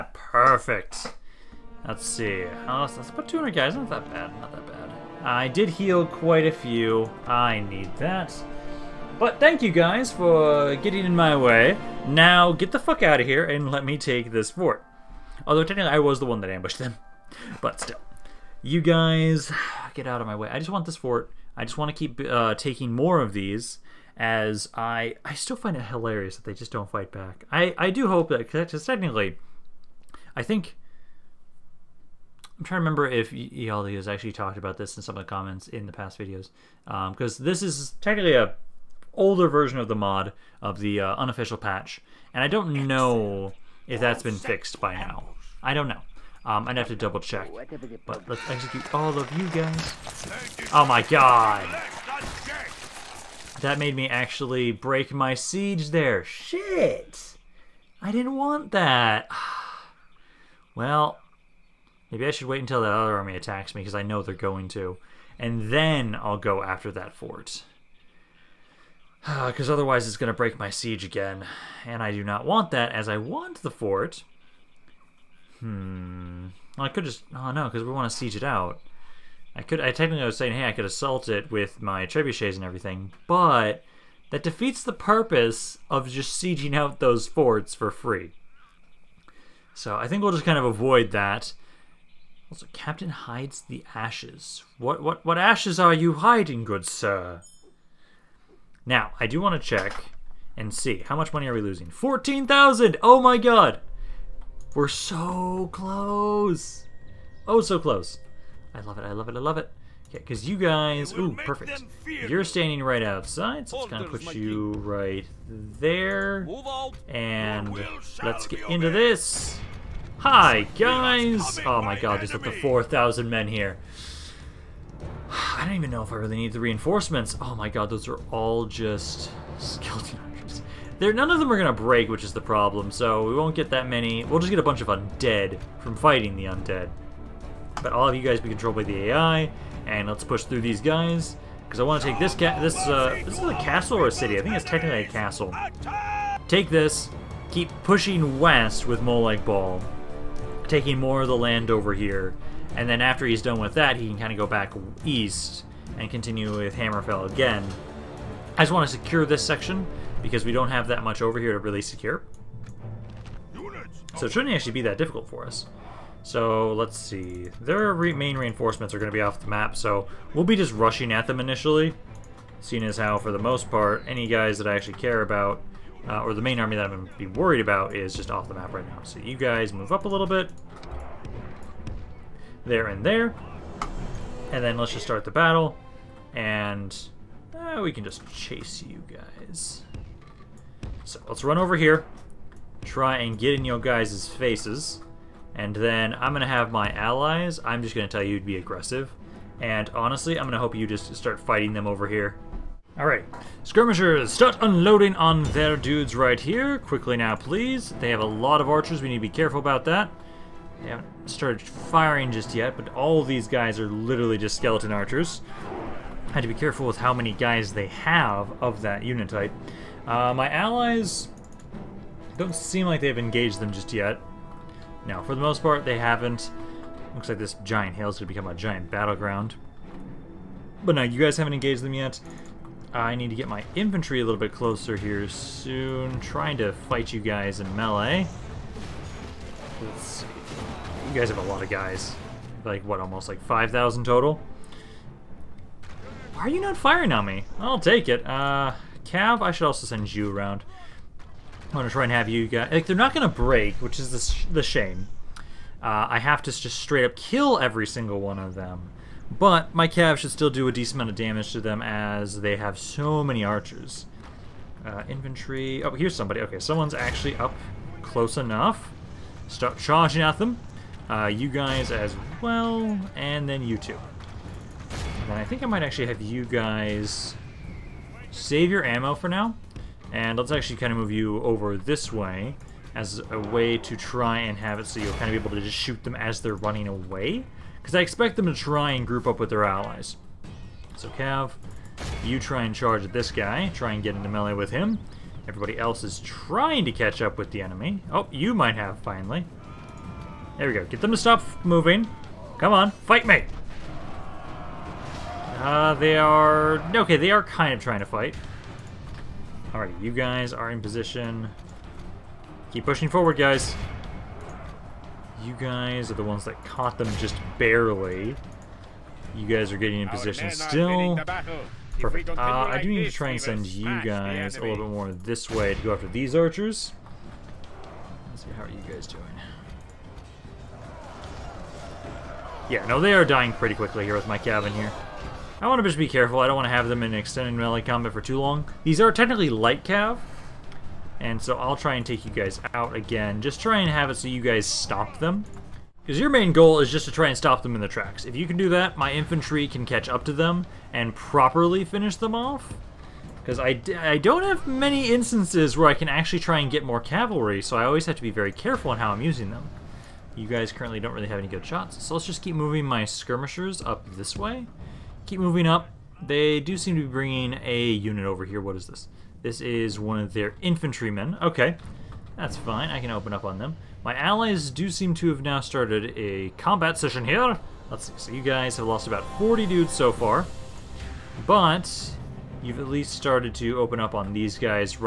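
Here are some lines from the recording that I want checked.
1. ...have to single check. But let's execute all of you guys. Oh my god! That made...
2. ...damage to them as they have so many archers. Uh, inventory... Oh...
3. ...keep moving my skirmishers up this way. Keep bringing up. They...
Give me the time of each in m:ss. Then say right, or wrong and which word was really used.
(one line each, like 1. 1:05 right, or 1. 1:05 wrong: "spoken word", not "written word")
1. 0:46 wrong: "double", not "single"
2. 4:21 right
3. 6:02 wrong: "moving", not "bringing".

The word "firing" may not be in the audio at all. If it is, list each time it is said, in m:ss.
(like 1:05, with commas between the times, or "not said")
3:31, 4:06.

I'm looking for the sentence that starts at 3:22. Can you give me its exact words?
Alright, skirmishers, start unloading on their dudes right here.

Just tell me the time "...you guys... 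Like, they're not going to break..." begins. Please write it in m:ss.
4:12.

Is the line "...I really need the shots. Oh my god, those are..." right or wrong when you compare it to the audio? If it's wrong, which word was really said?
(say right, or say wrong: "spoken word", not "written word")
wrong: "reinforcements", not "shots".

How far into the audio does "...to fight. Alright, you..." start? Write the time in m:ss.
5:07.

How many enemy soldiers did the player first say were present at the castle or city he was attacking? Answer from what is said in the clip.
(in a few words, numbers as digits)
4,000.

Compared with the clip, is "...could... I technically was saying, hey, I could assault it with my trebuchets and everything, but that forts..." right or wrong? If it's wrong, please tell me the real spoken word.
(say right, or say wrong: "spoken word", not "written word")
wrong: "defeats", not "forts".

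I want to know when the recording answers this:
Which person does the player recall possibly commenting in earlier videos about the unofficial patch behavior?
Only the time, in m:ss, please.
0:33.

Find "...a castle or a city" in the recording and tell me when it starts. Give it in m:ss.
2:23.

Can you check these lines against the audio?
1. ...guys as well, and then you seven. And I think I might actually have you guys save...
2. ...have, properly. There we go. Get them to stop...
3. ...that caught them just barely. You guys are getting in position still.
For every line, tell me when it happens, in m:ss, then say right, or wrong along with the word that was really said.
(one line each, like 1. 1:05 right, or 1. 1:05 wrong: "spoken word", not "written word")
1. 4:31 wrong: "two", not "seven"
2. 4:58 wrong: "finally", not "properly"
3. 5:16 right.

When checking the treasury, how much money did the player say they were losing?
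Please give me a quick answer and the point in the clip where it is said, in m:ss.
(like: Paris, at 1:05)
14,000, at 1:41.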